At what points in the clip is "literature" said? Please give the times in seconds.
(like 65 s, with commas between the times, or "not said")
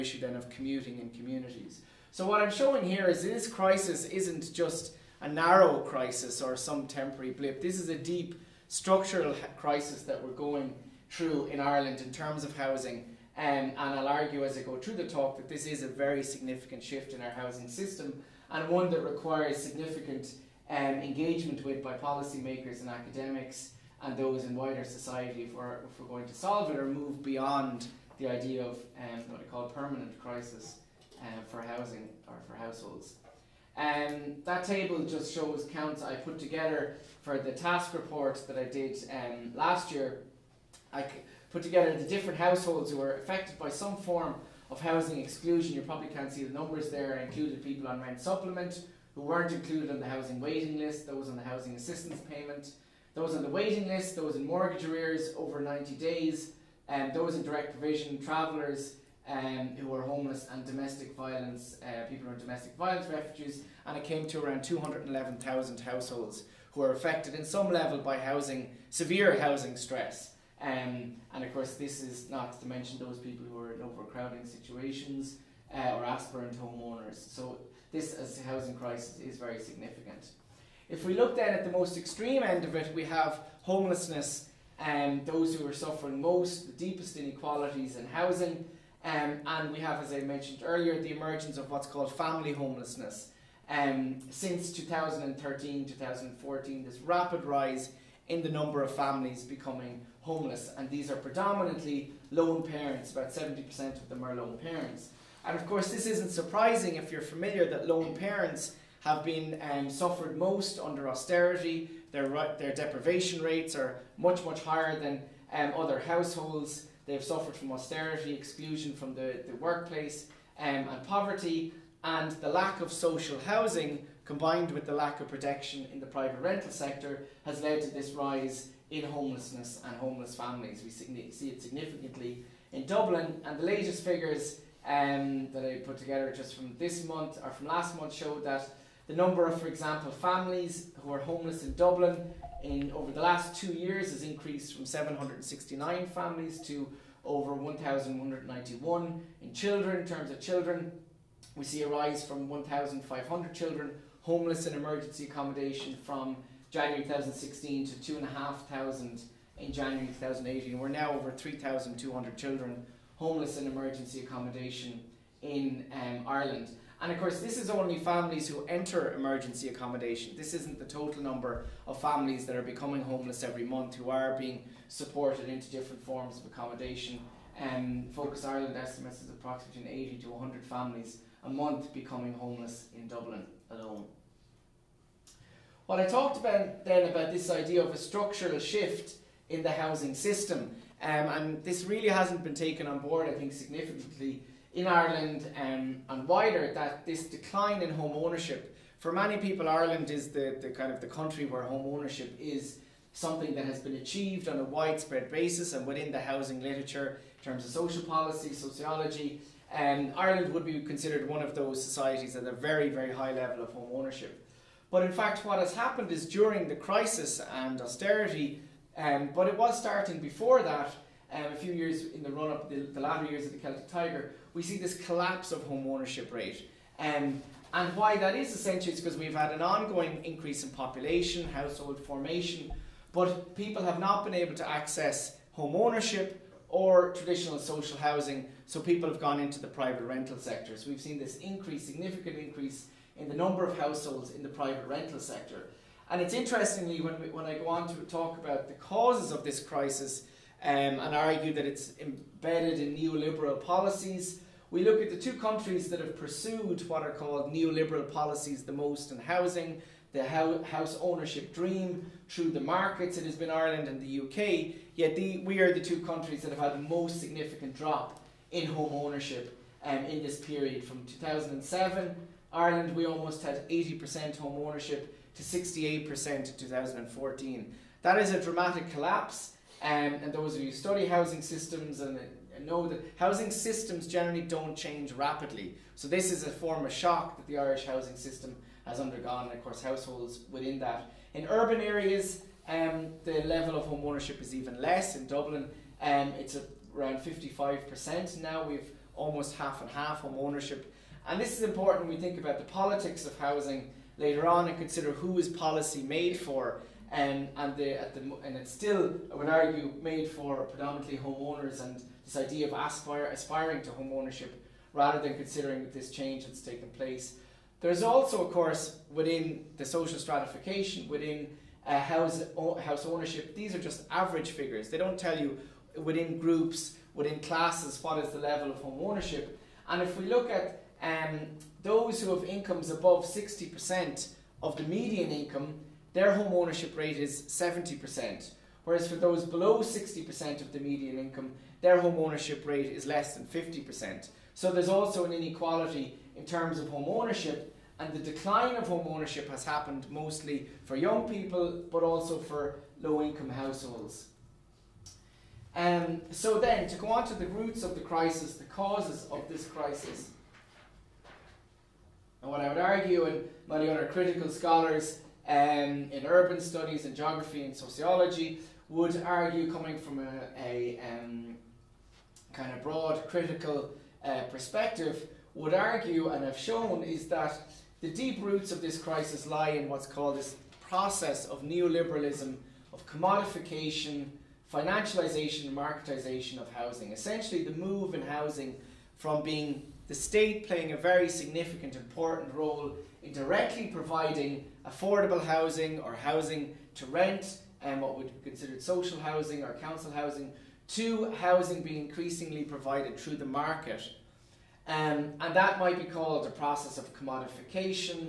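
206 s.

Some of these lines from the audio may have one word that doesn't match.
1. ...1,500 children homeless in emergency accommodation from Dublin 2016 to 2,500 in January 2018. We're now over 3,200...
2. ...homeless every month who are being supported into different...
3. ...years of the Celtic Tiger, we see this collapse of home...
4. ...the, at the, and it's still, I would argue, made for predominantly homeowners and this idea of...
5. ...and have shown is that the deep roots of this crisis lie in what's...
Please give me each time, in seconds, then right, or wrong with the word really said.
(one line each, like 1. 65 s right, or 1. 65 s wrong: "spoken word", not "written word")
1. 152 s wrong: "January", not "Dublin"
2. 173 s right
3. 223 s right
4. 307 s right
5. 376 s right.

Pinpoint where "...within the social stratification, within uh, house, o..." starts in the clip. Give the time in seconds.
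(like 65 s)
319 s.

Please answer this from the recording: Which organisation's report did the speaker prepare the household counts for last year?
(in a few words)
TASC.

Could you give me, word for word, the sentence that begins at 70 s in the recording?
Um, and of course, this is not to mention those people who are in overcrowding situations uh, or aspirant homeowners.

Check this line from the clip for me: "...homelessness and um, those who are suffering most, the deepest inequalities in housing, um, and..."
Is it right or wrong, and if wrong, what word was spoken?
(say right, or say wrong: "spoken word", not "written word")
right.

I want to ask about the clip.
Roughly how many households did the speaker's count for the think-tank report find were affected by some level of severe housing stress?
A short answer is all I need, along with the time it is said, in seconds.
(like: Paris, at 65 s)
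211,000, at 64 s.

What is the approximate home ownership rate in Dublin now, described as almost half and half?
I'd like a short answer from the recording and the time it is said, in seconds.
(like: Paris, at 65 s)
55%, at 297 s.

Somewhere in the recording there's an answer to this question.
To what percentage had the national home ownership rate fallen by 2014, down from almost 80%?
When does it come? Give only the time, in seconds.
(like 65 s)
275 s.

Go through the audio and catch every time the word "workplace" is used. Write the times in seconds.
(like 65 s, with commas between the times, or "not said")
119 s.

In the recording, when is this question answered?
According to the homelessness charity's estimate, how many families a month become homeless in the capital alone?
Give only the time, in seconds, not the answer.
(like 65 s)
179 s.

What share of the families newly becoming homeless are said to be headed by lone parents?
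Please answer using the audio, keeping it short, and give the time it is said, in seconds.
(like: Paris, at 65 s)
70%, at 103 s.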